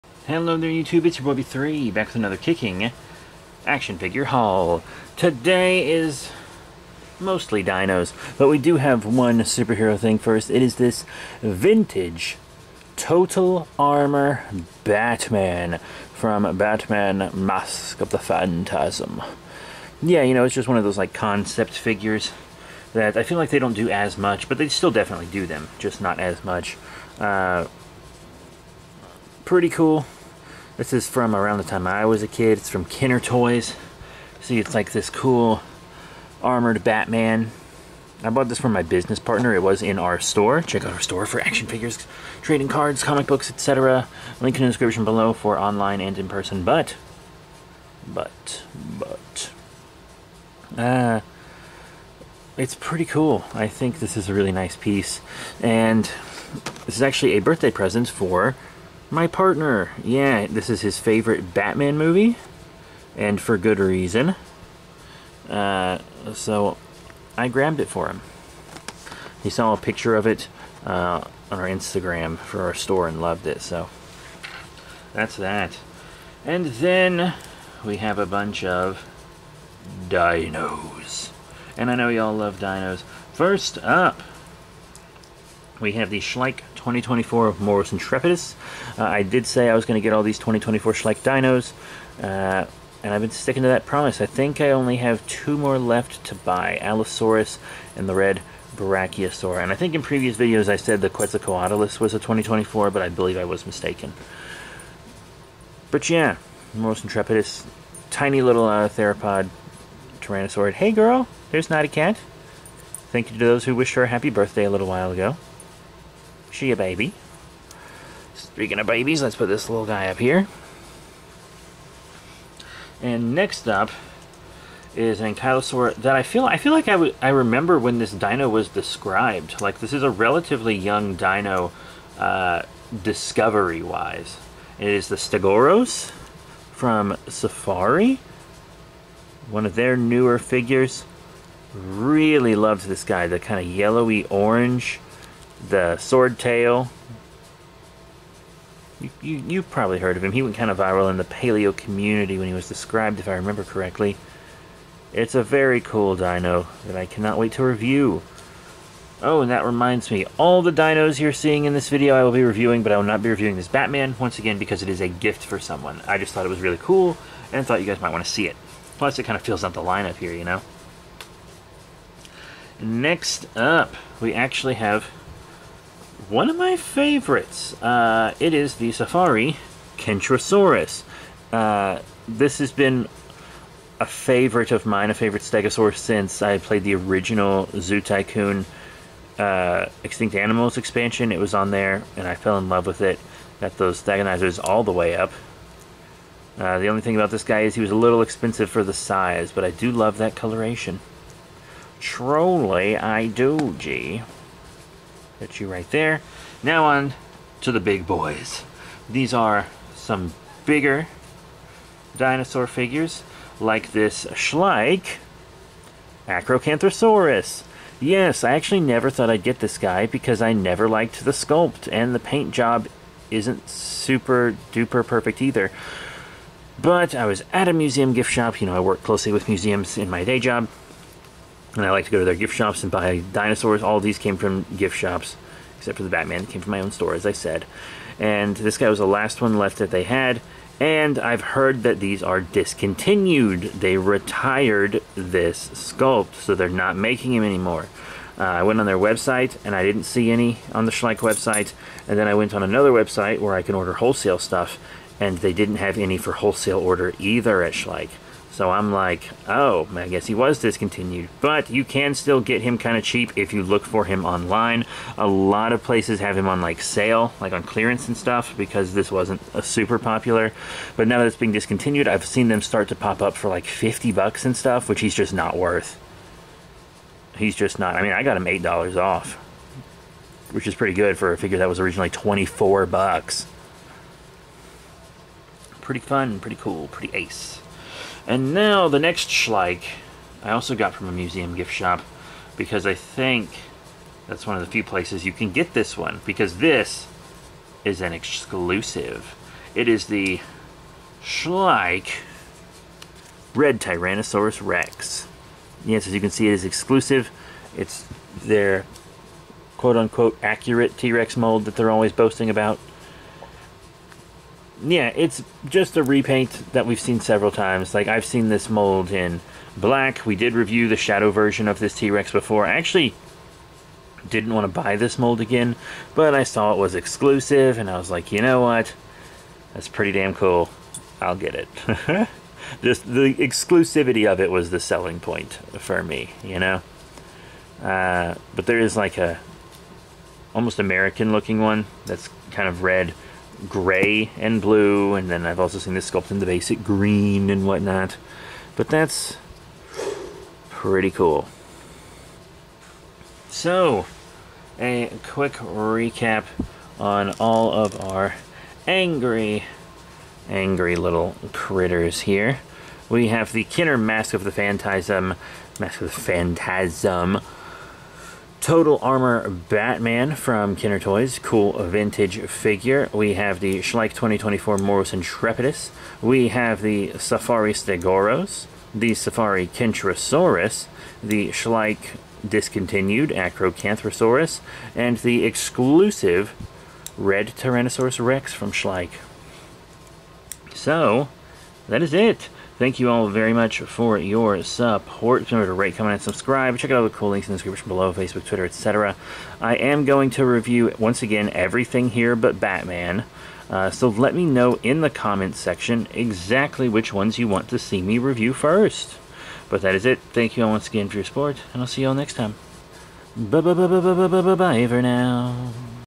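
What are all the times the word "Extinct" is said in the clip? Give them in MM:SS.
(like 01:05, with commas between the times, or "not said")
03:10.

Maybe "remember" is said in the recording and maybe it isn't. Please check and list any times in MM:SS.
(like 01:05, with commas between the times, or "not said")
02:07, 02:33, 06:35.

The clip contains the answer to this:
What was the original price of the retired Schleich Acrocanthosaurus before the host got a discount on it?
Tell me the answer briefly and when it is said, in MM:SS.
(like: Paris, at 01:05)
$24, at 04:42.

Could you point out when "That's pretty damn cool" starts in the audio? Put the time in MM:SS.
05:29.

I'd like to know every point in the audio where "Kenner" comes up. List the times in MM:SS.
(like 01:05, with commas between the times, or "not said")
00:32, 06:03, 06:10.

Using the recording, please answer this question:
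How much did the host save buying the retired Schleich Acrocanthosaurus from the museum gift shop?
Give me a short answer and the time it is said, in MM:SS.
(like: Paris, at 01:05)
$8, at 04:38.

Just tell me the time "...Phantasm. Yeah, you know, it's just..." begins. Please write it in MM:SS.
00:18.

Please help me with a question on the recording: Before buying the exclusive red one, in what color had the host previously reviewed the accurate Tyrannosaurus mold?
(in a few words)
Black.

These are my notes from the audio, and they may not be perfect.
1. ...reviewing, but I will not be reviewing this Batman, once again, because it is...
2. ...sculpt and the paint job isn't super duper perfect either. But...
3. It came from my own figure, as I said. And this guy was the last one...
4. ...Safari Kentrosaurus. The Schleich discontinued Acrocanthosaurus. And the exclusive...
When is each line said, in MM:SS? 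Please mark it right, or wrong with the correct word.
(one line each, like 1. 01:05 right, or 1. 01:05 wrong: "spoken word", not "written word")
1. 02:42 right
2. 03:41 right
3. 03:56 wrong: "store", not "figure"
4. 06:19 right.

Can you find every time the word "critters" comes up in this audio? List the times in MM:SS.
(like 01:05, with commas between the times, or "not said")
06:01.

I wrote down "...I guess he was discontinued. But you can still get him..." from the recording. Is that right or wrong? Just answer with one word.
right.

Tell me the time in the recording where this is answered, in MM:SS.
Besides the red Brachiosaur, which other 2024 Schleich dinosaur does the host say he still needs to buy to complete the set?
01:36.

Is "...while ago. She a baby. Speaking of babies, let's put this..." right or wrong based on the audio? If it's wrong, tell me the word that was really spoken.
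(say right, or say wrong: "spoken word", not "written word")
right.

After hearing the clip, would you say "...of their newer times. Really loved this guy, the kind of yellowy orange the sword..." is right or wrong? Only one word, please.
wrong.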